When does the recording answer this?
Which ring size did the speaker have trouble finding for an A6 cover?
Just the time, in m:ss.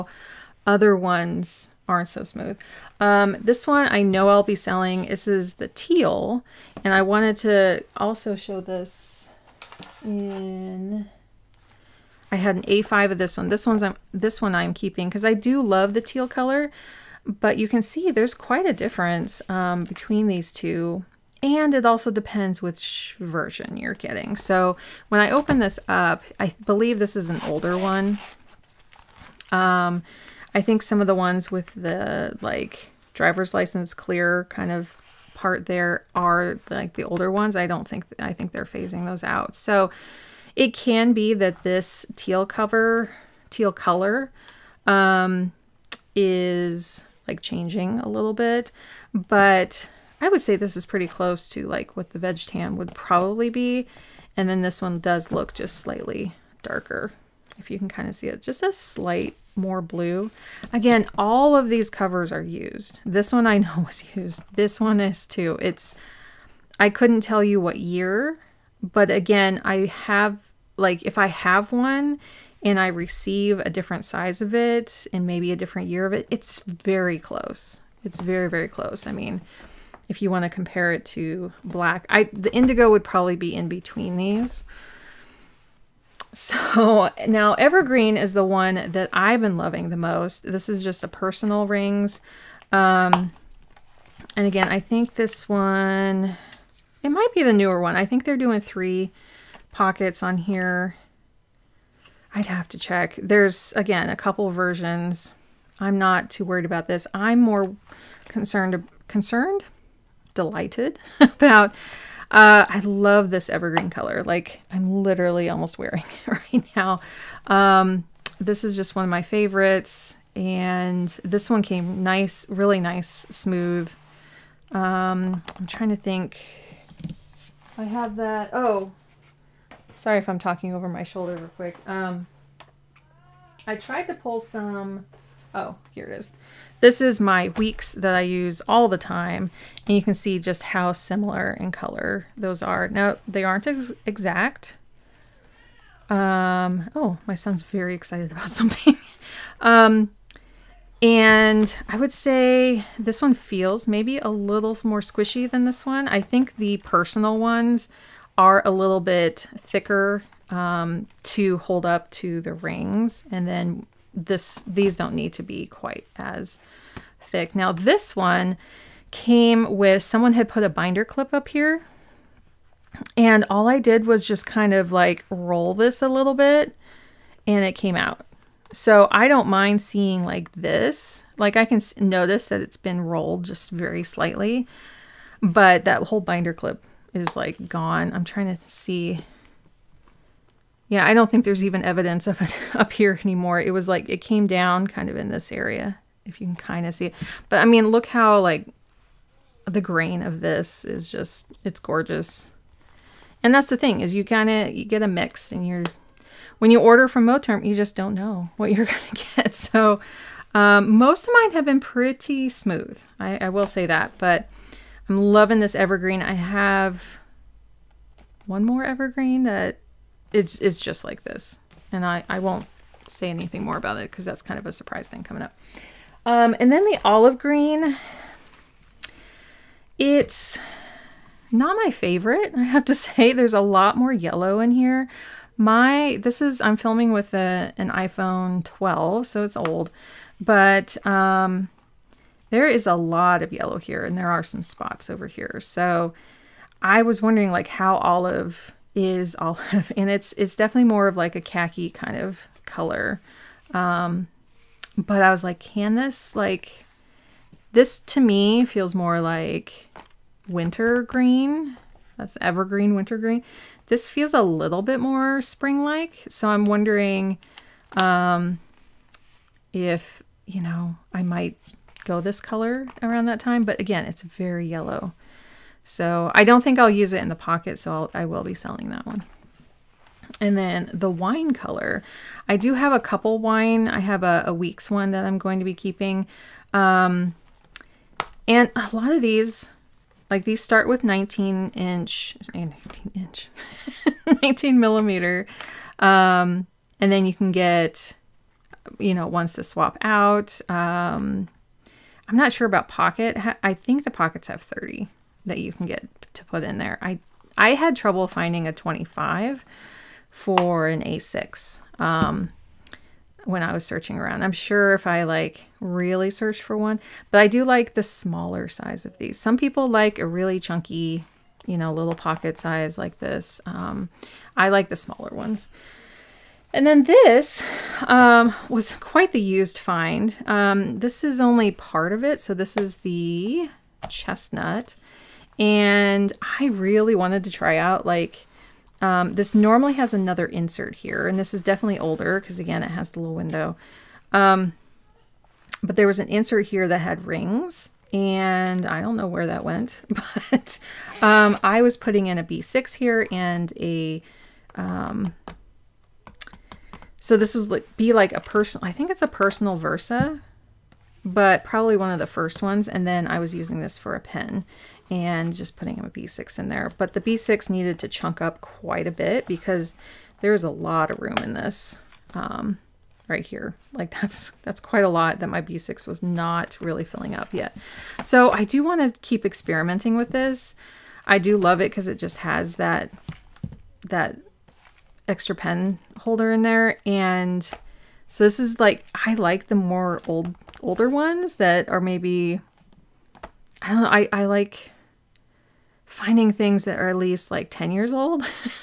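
5:08.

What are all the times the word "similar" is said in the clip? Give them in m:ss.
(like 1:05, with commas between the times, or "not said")
2:20.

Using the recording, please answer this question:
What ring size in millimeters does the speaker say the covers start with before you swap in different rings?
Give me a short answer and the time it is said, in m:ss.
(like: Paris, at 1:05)
19 millimeter, at 4:54.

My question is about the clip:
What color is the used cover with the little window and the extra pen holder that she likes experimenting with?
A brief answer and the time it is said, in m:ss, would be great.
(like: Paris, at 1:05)
Chestnut, at 5:34.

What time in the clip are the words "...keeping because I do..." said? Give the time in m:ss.
0:14.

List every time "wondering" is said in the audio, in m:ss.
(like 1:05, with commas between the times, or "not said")
4:07, 4:26.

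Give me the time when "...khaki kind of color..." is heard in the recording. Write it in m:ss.
4:11.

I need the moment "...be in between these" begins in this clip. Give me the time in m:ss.
1:23.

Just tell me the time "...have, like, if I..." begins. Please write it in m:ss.
1:09.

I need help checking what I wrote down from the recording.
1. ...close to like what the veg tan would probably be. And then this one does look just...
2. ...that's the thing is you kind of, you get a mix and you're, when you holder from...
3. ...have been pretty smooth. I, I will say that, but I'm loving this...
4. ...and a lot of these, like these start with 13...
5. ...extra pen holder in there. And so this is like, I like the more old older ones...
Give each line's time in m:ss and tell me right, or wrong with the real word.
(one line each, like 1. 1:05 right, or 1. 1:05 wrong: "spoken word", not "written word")
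1. 0:51 right
2. 3:23 wrong: "order", not "holder"
3. 3:31 right
4. 4:48 wrong: "19", not "13"
5. 6:25 right.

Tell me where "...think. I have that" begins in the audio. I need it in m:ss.
2:05.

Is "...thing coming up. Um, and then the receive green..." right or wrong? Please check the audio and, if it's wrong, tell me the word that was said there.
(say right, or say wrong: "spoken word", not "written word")
wrong: "olive", not "receive".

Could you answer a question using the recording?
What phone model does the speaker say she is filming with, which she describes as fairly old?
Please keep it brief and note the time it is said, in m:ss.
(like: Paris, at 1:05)
iPhone 12, at 3:57.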